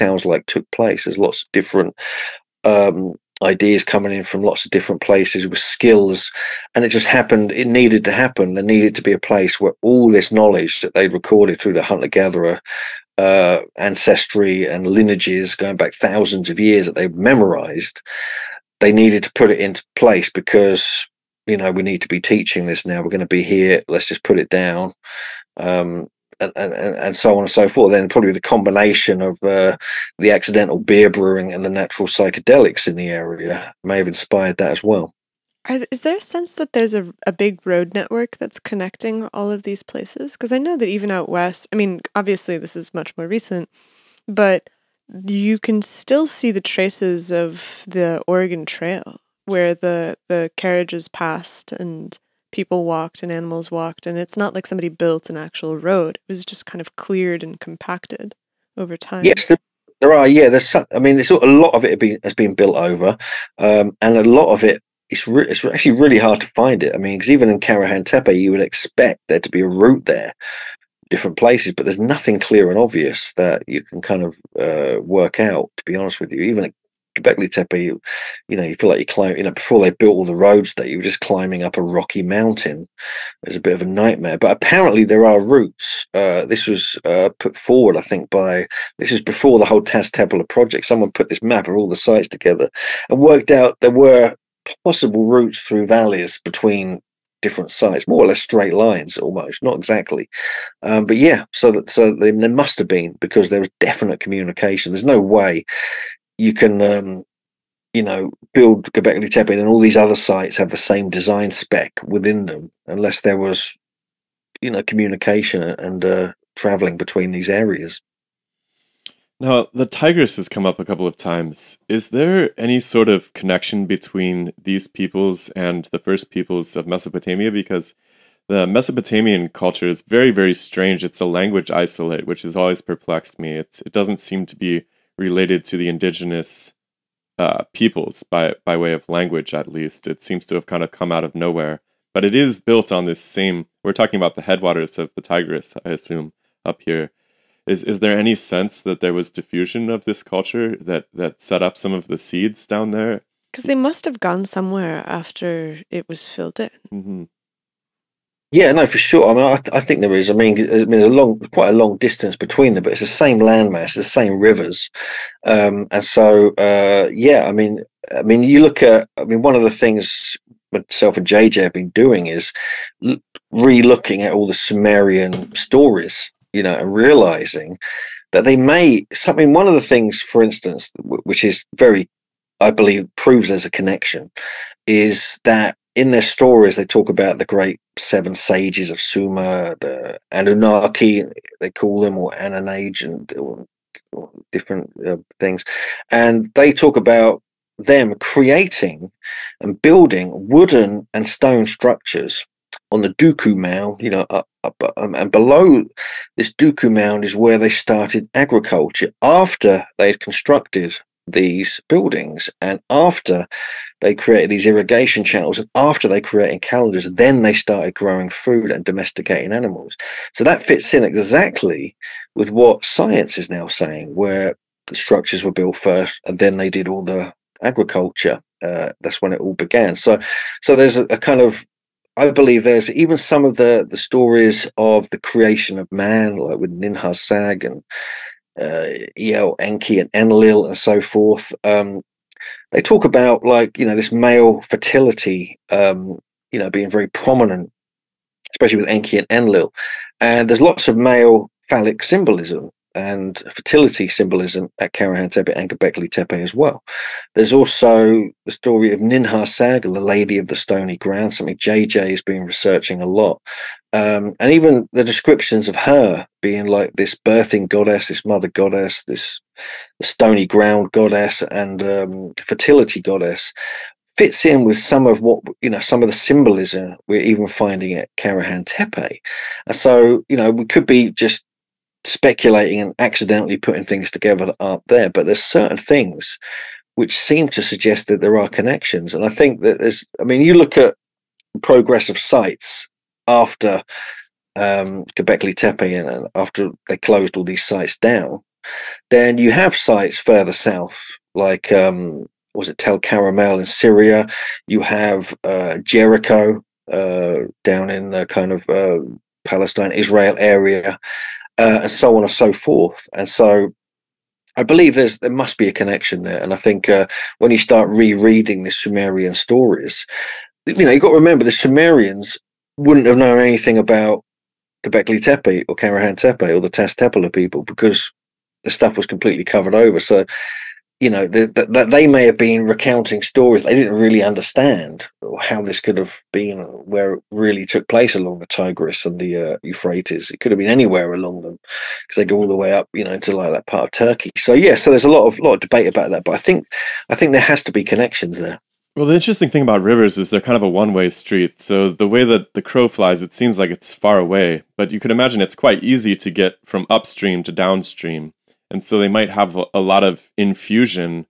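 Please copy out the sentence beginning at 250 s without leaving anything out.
And there's lots of male phallic symbolism and fertility symbolism at Karahan Tepe and Göbekli Tepe as well.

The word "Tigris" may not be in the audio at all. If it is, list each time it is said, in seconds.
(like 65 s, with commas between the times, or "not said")
119 s, 145 s, 338 s.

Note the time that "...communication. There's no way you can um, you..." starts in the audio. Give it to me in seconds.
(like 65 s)
104 s.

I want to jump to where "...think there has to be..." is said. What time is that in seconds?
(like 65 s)
347 s.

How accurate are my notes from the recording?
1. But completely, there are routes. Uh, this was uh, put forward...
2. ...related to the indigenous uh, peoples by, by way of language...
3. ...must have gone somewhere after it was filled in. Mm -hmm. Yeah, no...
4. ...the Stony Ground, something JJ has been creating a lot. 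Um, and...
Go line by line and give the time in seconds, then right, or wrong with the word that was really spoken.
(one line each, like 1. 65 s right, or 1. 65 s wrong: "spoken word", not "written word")
1. 84 s wrong: "apparently", not "completely"
2. 135 s right
3. 153 s right
4. 260 s wrong: "researching", not "creating".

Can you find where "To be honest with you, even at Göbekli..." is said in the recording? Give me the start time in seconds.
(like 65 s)
75 s.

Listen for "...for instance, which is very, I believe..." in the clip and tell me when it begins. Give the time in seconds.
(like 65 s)
180 s.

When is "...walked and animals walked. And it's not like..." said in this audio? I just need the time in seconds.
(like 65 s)
52 s.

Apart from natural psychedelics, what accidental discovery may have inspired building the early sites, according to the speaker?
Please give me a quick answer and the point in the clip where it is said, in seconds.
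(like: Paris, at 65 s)
beer brewing, at 30 s.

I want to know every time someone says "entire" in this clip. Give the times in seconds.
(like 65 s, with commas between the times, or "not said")
not said.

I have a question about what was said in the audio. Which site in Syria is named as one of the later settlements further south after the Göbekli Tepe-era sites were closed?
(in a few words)
Tell Qaramel.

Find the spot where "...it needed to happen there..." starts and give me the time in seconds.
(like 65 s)
7 s.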